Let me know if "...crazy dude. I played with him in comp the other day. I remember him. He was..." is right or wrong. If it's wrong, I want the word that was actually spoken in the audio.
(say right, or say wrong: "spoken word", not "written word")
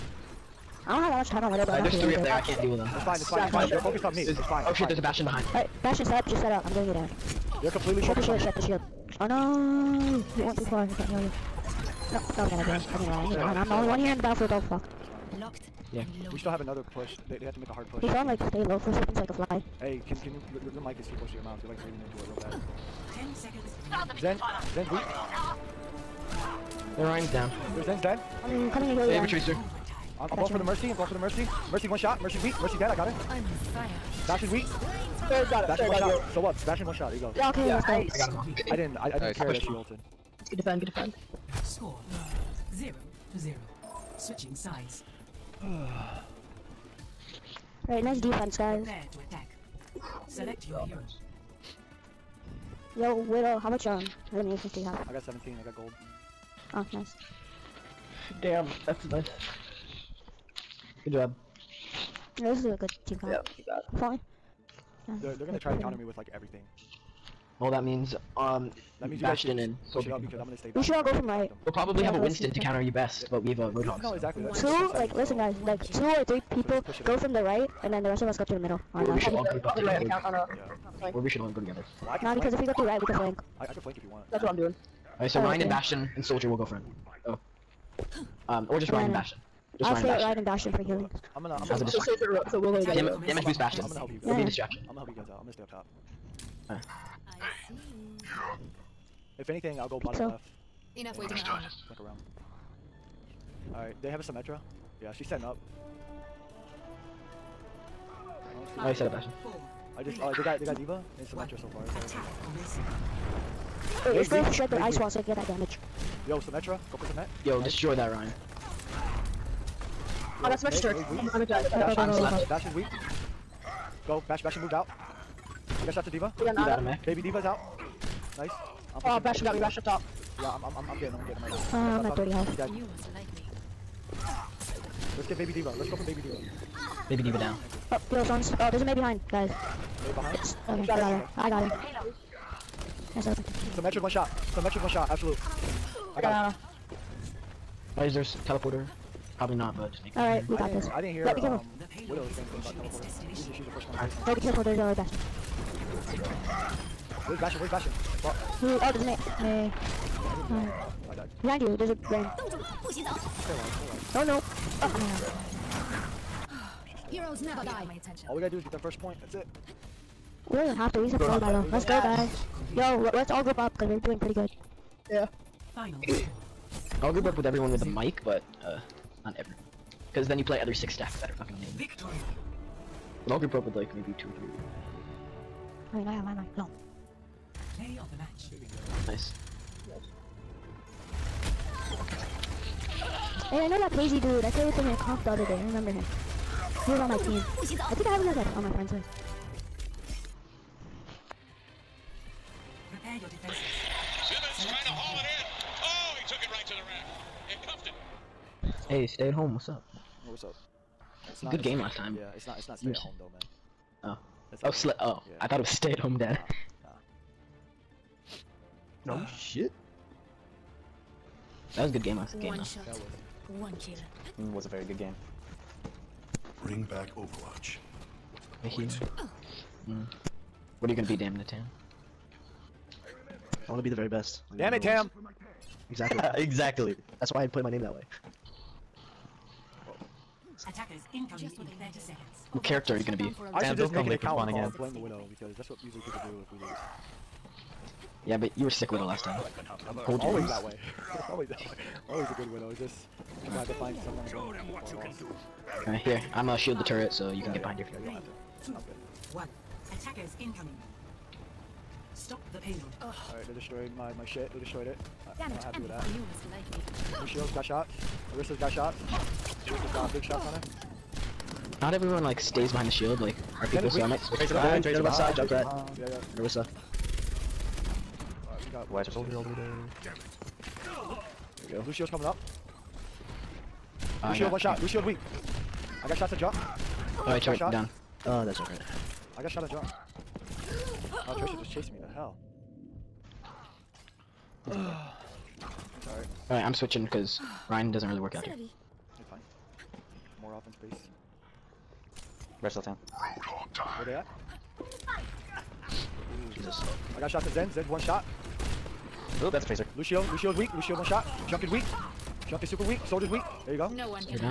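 right.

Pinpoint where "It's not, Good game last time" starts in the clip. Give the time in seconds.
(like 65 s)
211 s.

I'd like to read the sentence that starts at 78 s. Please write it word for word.
Or, or we should all together.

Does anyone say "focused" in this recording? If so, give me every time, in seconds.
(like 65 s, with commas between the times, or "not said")
3 s, 8 s.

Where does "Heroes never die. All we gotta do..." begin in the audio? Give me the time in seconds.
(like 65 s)
167 s.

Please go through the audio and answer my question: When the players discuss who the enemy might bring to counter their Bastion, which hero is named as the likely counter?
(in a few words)
Winston.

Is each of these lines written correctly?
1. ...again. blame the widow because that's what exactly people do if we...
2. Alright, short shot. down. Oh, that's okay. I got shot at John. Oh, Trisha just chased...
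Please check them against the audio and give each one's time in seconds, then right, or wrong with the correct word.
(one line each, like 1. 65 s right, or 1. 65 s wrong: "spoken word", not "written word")
1. 244 s wrong: "usually", not "exactly"
2. 287 s right.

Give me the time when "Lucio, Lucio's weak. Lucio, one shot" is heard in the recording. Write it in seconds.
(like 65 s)
309 s.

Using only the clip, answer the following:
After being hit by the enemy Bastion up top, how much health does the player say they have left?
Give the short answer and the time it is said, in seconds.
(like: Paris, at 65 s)
30, at 132 s.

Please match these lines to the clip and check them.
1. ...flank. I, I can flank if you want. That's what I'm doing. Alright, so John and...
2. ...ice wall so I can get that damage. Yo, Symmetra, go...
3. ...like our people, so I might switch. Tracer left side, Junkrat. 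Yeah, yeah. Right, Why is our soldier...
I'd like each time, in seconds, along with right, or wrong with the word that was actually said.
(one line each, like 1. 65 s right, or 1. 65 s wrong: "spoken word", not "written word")
1. 83 s wrong: "Rein", not "John"
2. 114 s right
3. 273 s right.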